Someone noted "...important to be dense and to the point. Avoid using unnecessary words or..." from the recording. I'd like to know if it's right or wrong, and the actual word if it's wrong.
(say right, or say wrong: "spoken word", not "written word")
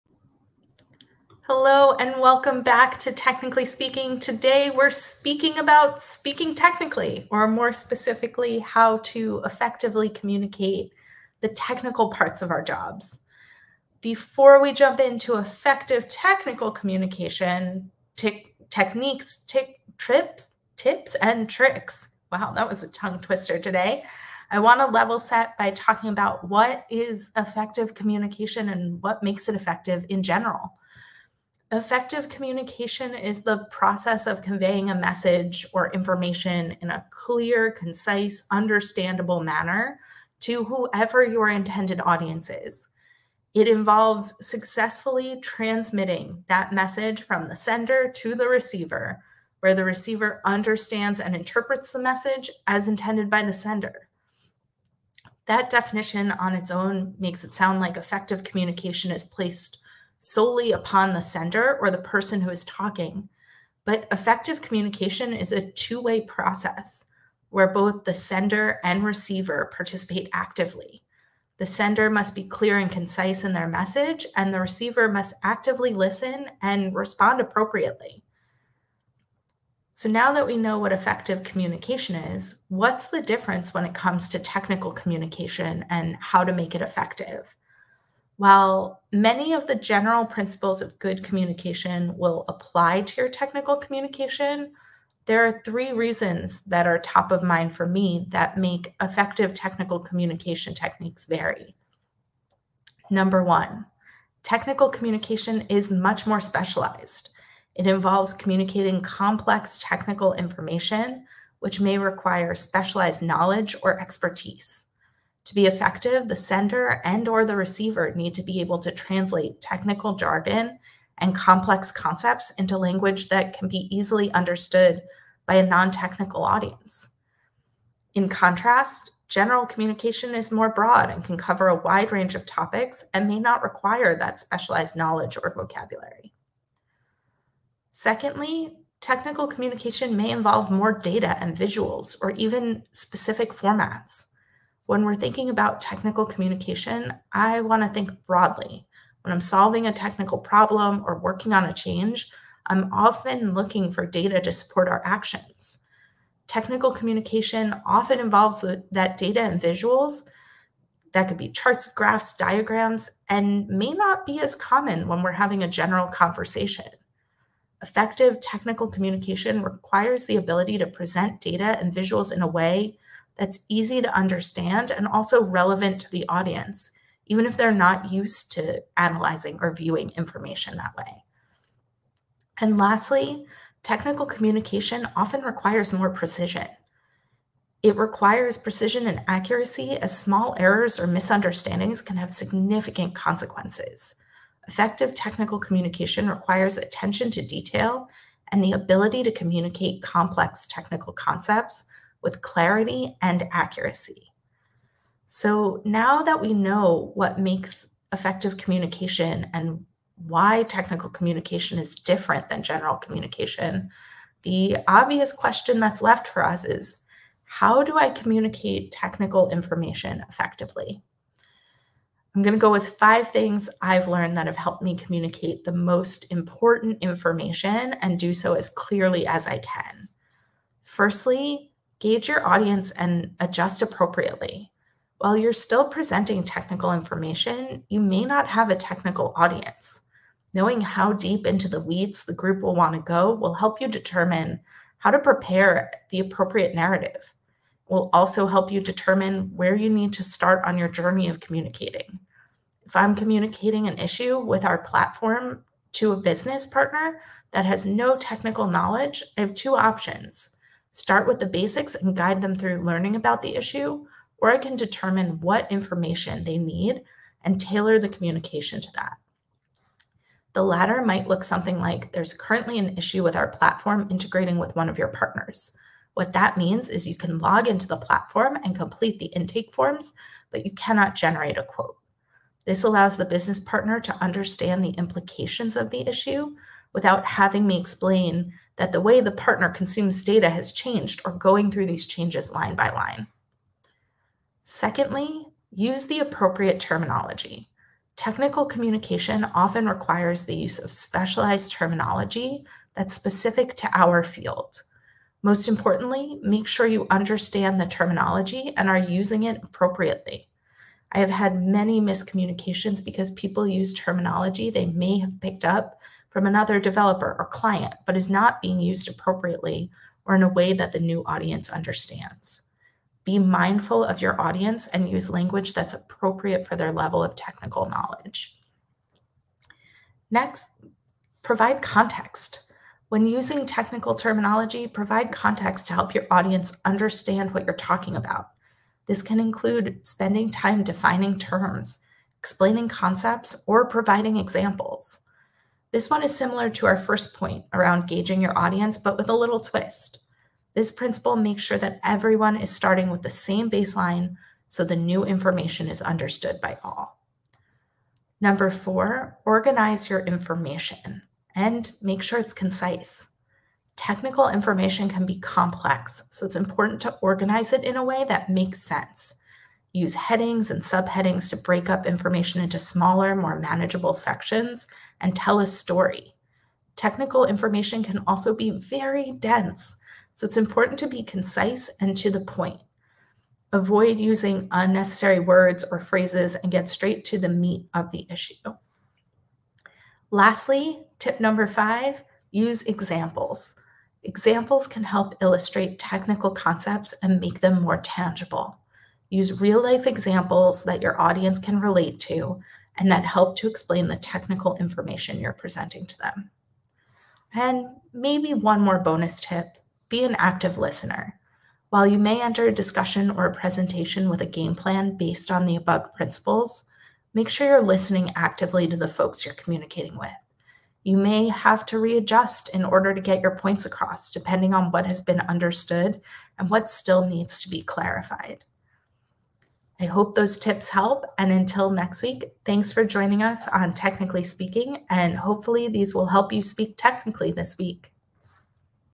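wrong: "concise", not "dense".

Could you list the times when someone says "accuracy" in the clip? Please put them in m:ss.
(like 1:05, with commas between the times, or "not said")
3:09, 3:23.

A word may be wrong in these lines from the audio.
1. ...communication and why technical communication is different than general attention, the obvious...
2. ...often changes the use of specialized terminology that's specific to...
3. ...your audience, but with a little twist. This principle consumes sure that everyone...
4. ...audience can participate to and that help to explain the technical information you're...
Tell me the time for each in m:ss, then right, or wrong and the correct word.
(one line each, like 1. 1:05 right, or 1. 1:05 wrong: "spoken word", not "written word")
1. 3:28 wrong: "communication", not "attention"
2. 4:59 wrong: "requires", not "changes"
3. 5:48 wrong: "makes", not "consumes"
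4. 6:41 wrong: "relate", not "participate".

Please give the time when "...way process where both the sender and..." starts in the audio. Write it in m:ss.
1:05.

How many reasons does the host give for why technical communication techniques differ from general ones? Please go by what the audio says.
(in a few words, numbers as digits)
3.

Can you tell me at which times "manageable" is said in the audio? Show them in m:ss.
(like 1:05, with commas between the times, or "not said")
6:13.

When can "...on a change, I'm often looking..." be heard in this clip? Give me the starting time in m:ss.
2:31.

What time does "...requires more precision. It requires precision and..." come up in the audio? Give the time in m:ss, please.
3:05.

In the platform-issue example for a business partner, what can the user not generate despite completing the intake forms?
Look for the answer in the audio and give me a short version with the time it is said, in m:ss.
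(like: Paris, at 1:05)
A quote, at 4:41.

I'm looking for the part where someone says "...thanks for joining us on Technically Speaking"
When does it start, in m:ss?
7:12.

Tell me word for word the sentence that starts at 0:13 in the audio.
Before we jump into effective technical communication, techniques, trips, tips, and tricks.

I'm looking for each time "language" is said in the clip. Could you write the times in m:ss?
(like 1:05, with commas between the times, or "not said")
2:02, 5:25.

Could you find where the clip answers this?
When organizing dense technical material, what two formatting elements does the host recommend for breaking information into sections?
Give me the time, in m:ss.
6:10.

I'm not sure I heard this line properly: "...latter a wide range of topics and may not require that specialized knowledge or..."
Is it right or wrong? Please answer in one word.
wrong.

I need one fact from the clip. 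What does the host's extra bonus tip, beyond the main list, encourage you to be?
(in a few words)
An active listener.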